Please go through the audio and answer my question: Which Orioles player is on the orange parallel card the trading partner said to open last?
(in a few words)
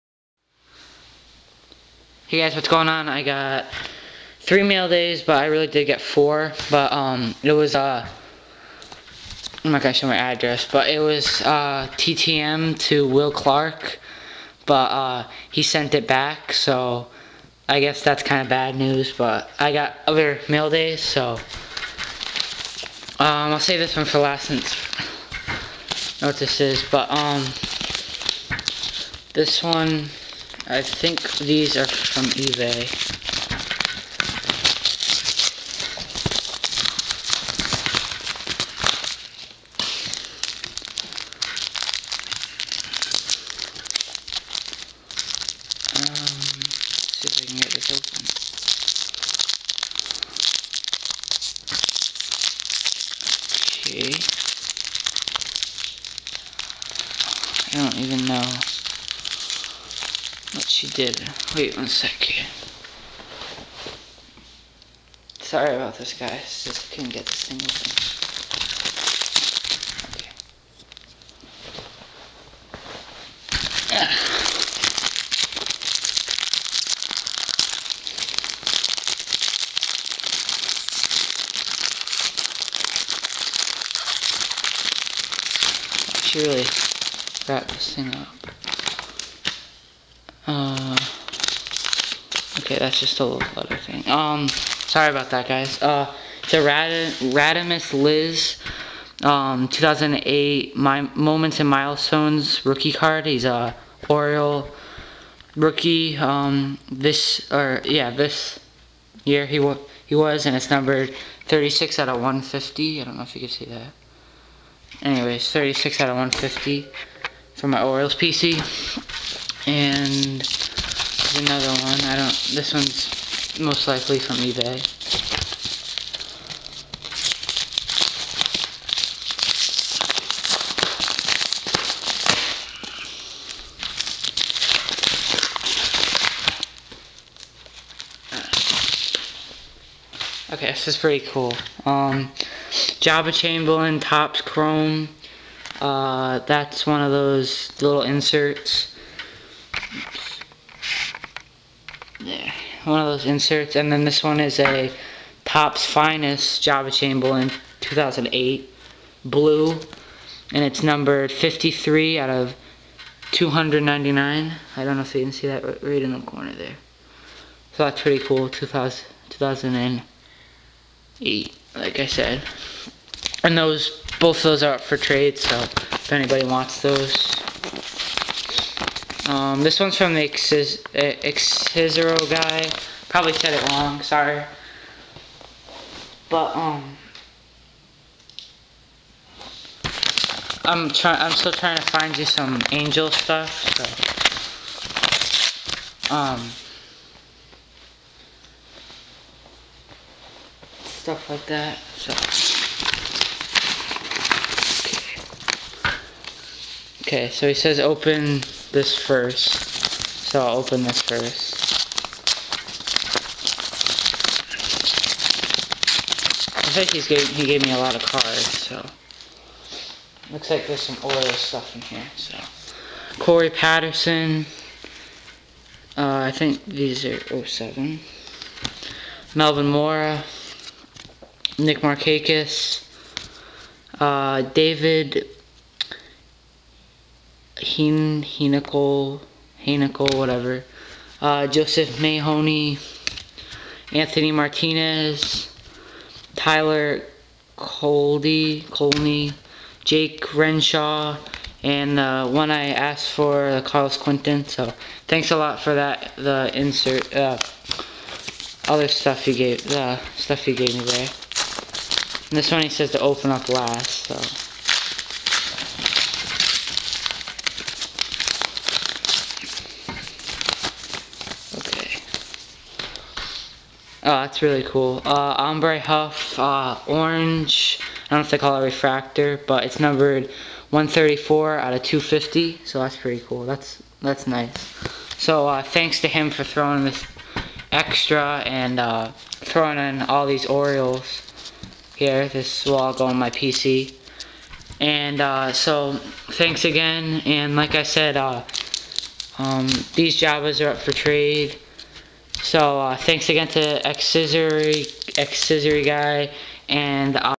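Aubrey Huff.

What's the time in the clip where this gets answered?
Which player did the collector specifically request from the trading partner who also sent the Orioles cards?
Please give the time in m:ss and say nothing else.
4:13.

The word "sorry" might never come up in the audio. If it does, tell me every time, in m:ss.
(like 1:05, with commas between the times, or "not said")
1:05, 1:34, 3:04.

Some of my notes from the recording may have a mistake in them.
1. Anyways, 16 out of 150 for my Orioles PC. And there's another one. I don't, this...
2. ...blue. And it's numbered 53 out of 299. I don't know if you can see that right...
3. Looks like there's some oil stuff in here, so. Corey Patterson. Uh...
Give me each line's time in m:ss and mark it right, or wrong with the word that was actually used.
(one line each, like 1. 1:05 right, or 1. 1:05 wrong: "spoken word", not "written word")
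1. 1:55 wrong: "36", not "16"
2. 2:39 right
3. 3:40 right.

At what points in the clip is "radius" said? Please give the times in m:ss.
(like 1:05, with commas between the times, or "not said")
not said.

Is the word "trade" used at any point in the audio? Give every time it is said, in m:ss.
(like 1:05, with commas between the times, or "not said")
2:54, 5:00.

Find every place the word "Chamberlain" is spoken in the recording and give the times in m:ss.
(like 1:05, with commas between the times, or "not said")
2:23, 2:36.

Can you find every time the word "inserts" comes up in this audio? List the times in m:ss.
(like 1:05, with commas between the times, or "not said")
2:28, 2:33, 4:16.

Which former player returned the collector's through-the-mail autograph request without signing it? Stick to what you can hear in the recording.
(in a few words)
Will Clark.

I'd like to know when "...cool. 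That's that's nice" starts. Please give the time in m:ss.
4:43.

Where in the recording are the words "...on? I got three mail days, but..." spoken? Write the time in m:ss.
0:02.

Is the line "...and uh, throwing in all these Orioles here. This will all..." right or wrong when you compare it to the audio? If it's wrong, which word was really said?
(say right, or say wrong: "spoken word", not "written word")
right.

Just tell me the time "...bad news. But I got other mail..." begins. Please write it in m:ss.
0:18.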